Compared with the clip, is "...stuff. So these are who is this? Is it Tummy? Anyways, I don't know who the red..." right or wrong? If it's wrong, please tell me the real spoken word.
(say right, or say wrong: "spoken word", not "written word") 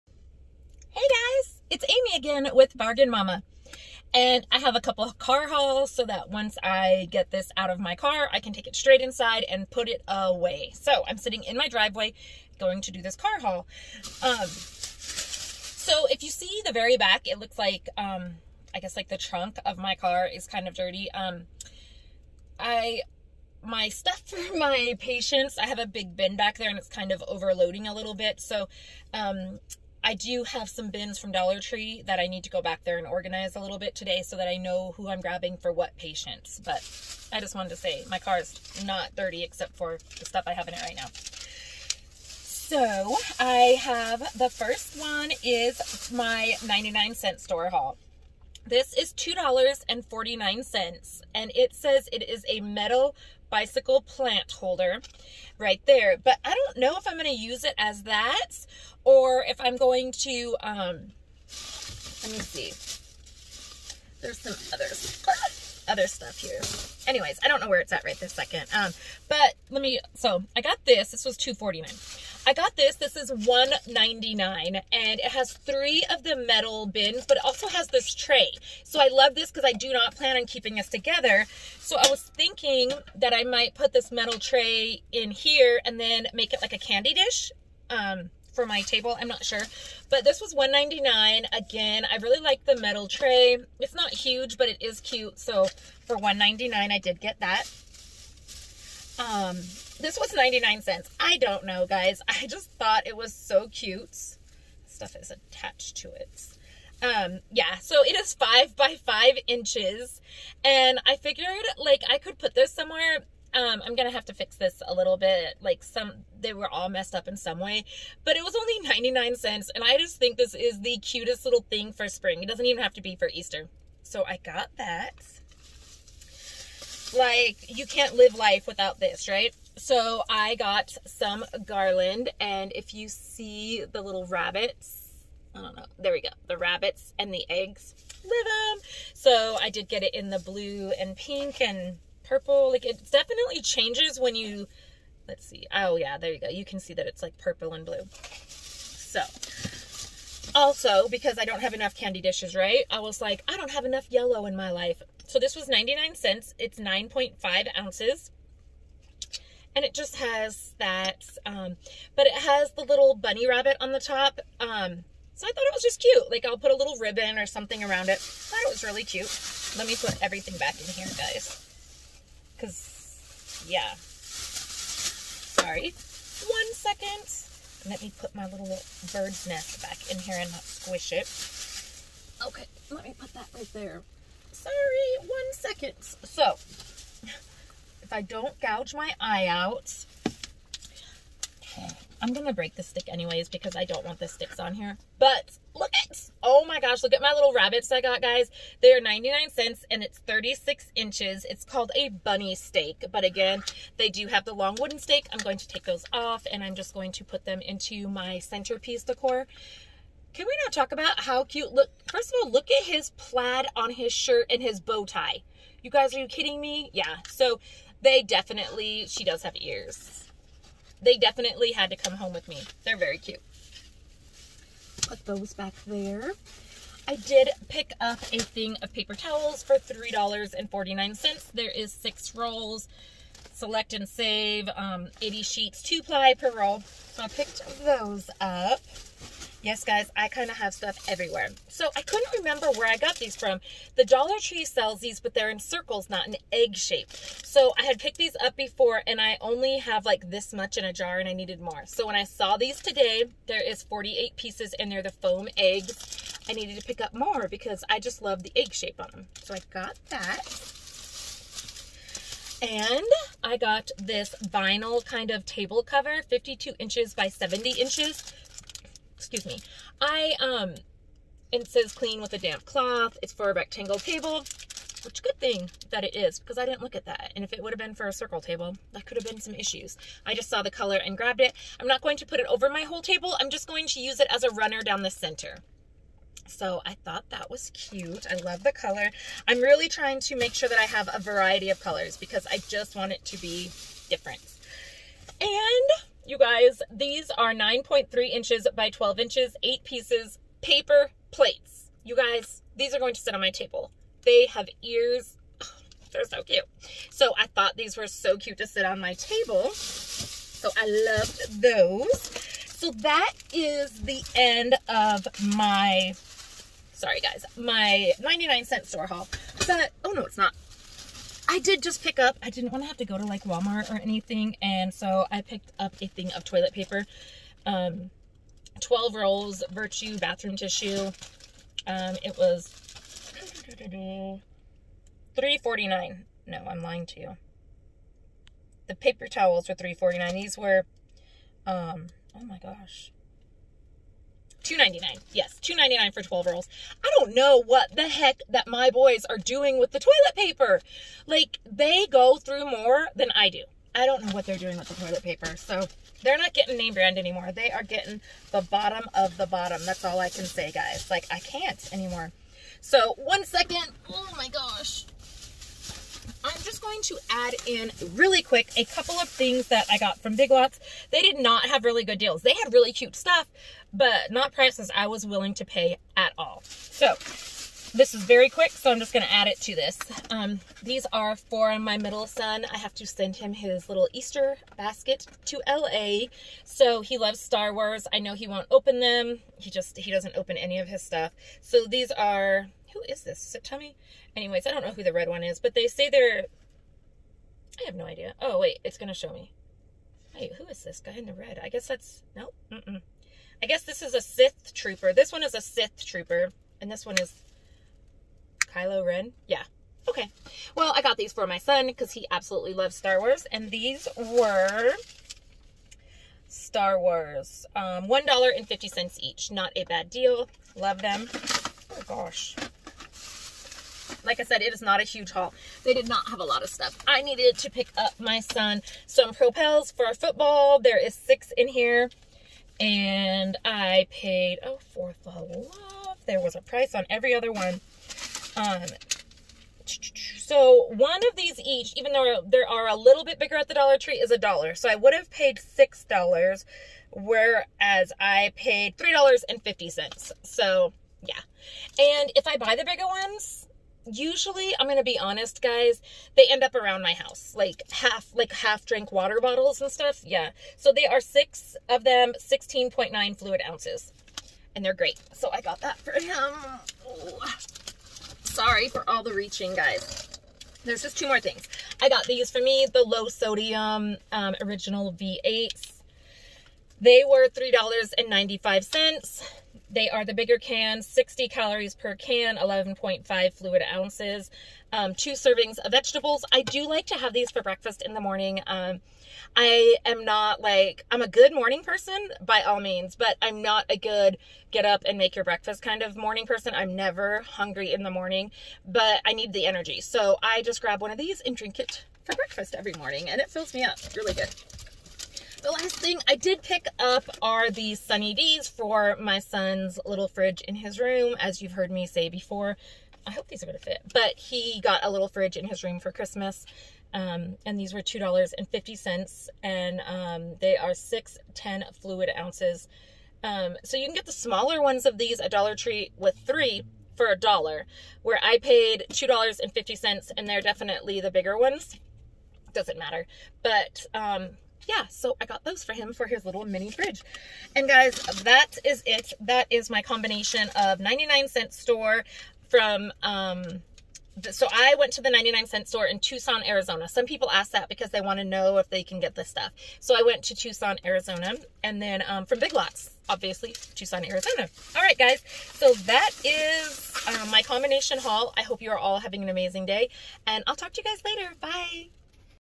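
right.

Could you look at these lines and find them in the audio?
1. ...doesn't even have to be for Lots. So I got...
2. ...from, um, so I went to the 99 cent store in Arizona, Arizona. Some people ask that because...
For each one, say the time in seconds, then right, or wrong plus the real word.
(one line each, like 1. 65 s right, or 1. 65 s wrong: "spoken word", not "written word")
1. 122 s wrong: "Easter", not "Lots"
2. 542 s wrong: "Tucson", not "Arizona".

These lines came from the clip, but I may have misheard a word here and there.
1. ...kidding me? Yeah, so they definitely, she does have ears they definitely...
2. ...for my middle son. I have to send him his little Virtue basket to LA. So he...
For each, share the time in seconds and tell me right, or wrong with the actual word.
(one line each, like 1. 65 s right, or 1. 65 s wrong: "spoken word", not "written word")
1. 216 s right
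2. 381 s wrong: "Easter", not "Virtue".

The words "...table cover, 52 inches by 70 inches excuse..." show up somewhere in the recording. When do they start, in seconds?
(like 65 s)
265 s.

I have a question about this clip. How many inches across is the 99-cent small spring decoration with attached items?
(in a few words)
5 by 5 inches.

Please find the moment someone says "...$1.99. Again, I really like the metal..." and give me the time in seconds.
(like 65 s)
90 s.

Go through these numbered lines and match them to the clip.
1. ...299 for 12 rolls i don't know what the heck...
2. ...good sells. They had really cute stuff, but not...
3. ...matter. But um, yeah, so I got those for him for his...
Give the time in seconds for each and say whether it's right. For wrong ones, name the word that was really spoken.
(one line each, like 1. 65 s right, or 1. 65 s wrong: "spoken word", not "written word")
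1. 345 s right
2. 372 s wrong: "deals", not "sells"
3. 532 s right.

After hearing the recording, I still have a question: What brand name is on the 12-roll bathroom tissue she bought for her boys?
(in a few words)
Virtue.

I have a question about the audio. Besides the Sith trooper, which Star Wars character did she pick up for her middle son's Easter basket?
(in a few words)
Kylo Ren.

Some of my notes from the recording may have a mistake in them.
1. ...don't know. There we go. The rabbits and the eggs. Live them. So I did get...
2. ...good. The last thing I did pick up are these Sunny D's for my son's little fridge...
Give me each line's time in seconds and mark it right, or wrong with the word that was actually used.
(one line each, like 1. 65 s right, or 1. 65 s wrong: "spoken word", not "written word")
1. 135 s right
2. 504 s right.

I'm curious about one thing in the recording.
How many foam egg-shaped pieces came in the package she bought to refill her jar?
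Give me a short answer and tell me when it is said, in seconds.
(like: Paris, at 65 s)
48, at 253 s.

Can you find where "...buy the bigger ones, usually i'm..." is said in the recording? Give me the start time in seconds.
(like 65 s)
452 s.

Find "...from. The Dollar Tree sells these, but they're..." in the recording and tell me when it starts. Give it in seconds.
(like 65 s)
243 s.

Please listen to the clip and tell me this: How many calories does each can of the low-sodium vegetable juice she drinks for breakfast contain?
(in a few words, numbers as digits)
60.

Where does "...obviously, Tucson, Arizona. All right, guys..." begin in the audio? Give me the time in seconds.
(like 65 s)
553 s.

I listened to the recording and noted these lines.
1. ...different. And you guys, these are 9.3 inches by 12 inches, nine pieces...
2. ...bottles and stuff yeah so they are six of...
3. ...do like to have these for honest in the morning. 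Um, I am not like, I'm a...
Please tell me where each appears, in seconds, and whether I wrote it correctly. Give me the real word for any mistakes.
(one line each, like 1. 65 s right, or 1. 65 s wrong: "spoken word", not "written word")
1. 294 s wrong: "eight", not "nine"
2. 459 s right
3. 486 s wrong: "breakfast", not "honest".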